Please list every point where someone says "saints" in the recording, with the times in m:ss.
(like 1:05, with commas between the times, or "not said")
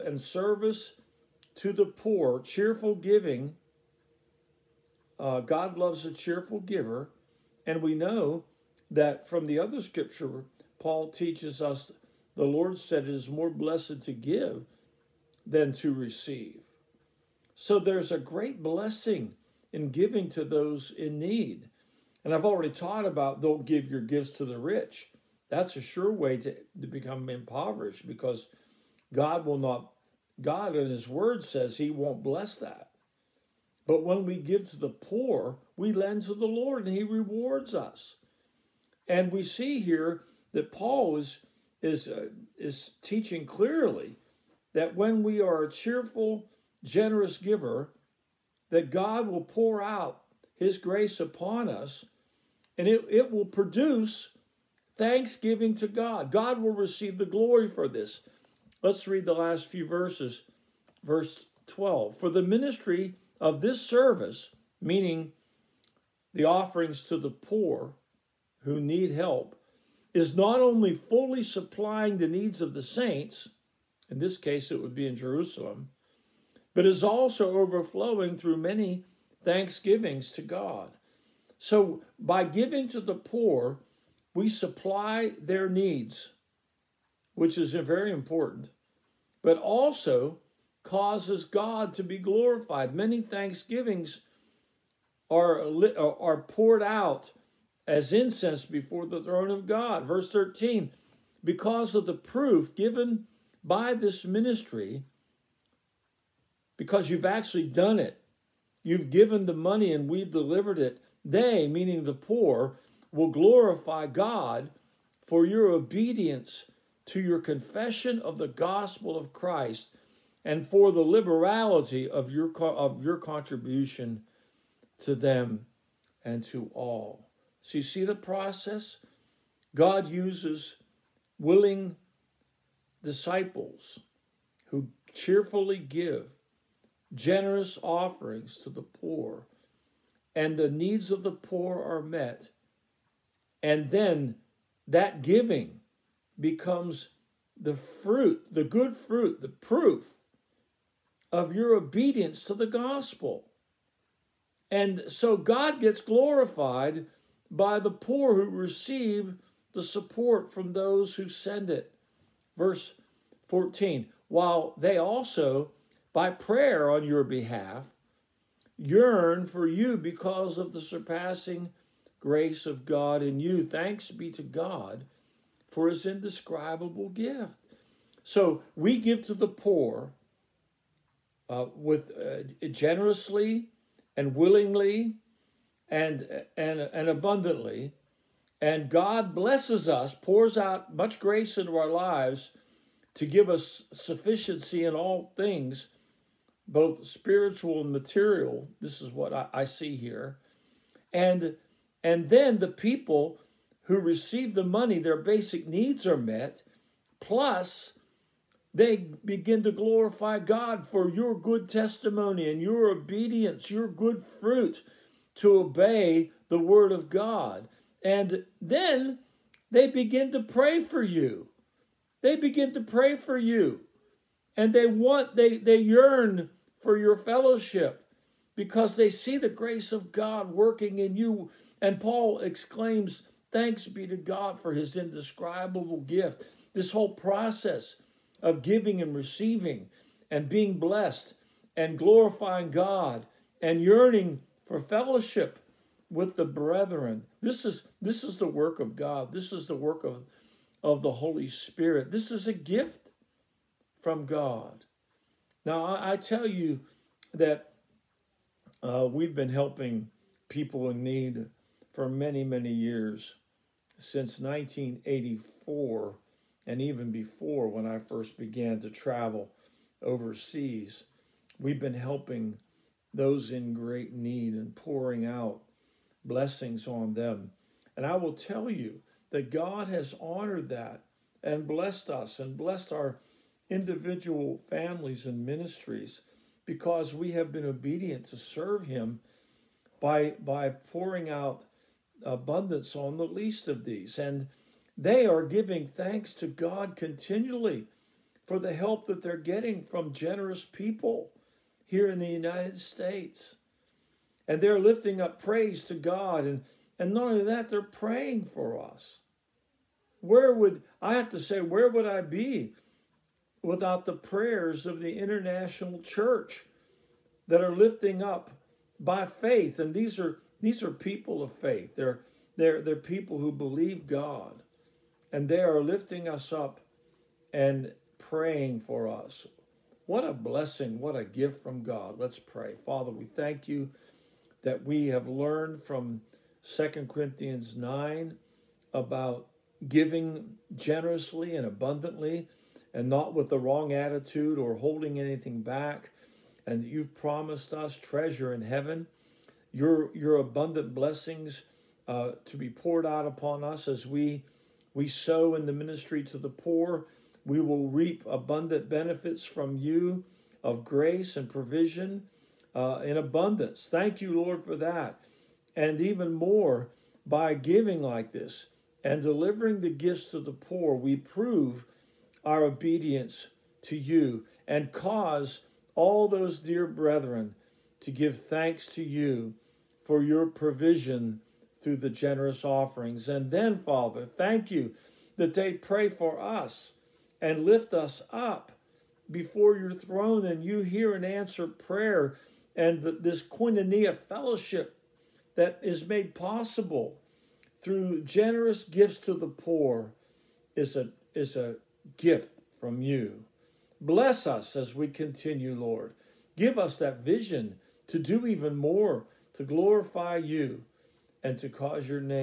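1:12.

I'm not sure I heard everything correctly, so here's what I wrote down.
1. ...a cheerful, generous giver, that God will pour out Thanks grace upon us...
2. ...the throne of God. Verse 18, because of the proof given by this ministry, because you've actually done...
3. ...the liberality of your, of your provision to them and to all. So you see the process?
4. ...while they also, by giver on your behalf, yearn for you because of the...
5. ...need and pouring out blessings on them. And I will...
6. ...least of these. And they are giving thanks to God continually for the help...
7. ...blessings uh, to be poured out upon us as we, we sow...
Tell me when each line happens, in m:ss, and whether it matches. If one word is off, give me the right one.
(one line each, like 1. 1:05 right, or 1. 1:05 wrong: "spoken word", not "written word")
1. 0:45 wrong: "His", not "Thanks"
2. 1:39 wrong: "13", not "18"
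3. 2:00 wrong: "contribution", not "provision"
4. 2:44 wrong: "prayer", not "giver"
5. 4:34 right
6. 4:53 right
7. 5:50 right.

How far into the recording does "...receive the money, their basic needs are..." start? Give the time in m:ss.
3:23.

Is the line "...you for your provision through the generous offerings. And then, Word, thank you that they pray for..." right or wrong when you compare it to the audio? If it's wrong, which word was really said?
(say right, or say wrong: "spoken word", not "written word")
wrong: "Father", not "Word".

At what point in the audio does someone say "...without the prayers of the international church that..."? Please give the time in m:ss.
5:13.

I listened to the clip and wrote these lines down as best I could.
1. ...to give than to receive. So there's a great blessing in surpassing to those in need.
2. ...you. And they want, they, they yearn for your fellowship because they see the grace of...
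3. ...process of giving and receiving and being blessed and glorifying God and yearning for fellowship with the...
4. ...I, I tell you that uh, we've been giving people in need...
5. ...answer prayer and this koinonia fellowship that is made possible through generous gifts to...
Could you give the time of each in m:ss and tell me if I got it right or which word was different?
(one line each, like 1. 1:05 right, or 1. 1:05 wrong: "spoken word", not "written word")
1. 0:14 wrong: "giving", not "surpassing"
2. 3:43 right
3. 3:57 right
4. 4:15 wrong: "helping", not "giving"
5. 6:31 right.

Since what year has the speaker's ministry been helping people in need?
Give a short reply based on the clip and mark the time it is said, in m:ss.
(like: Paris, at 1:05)
1984, at 4:24.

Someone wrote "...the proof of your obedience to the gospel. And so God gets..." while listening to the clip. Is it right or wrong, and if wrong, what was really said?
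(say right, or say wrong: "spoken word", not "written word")
right.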